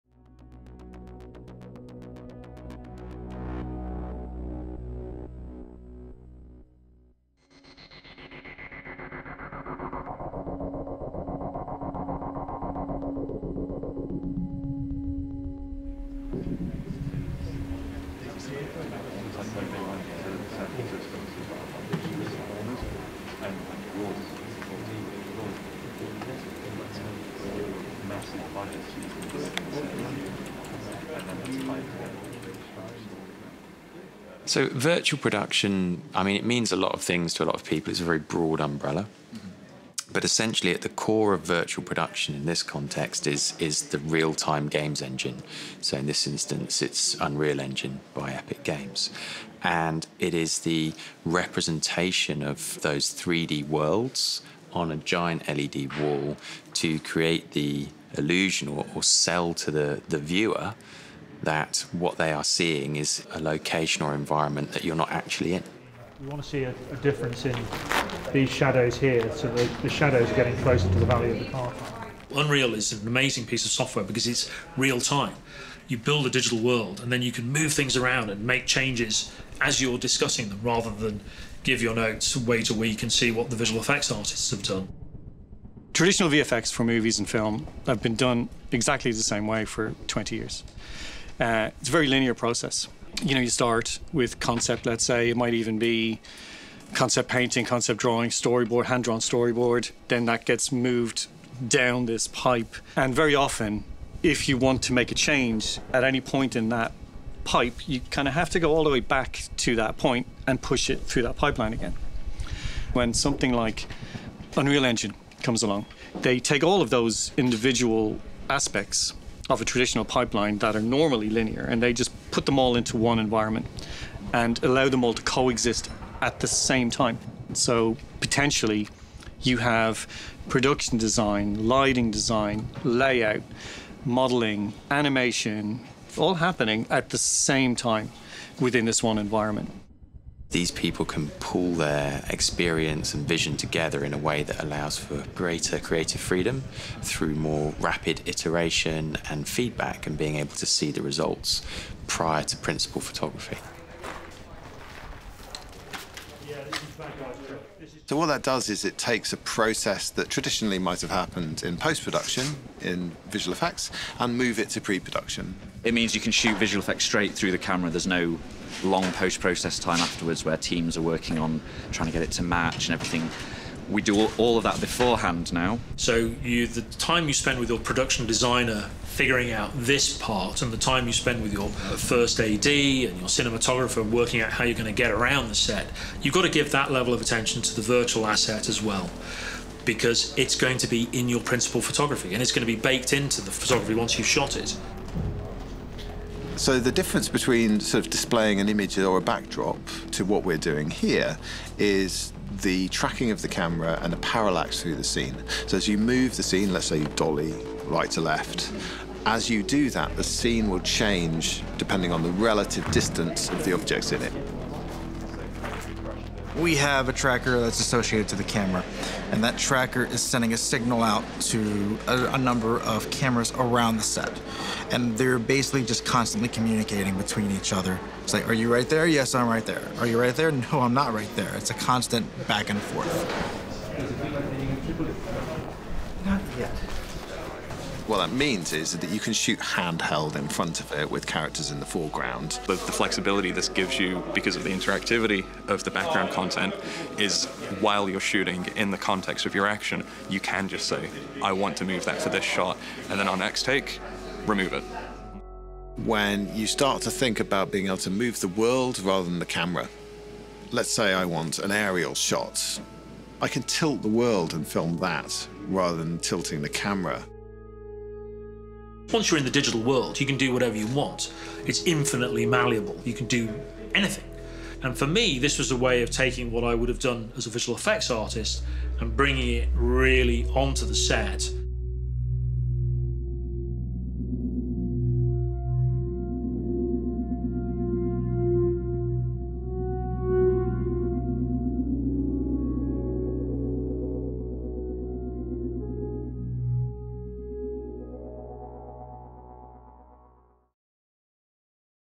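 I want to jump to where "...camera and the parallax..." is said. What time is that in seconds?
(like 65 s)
203 s.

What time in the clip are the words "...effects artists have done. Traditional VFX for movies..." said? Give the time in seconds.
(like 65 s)
83 s.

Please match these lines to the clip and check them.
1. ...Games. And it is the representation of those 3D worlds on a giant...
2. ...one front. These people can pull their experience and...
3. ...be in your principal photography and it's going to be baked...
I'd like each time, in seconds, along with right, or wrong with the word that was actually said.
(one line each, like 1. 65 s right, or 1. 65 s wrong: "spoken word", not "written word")
1. 48 s right
2. 139 s wrong: "environment", not "front"
3. 190 s right.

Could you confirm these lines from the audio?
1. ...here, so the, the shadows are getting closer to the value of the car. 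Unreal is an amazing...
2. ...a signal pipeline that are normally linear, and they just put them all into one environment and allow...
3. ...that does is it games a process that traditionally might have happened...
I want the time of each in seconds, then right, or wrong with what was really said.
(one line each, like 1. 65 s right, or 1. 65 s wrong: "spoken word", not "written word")
1. 68 s right
2. 119 s wrong: "traditional", not "signal"
3. 158 s wrong: "takes", not "games".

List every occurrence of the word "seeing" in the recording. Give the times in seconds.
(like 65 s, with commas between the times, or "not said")
62 s.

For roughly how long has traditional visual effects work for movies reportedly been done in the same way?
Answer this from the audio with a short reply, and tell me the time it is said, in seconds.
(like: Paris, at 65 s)
20 years, at 90 s.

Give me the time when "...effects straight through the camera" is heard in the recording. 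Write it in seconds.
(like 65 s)
166 s.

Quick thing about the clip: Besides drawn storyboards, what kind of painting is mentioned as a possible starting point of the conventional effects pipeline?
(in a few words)
Concept painting.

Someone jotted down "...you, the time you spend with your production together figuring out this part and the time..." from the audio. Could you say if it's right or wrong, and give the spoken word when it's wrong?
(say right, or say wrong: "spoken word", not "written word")
wrong: "designer", not "together".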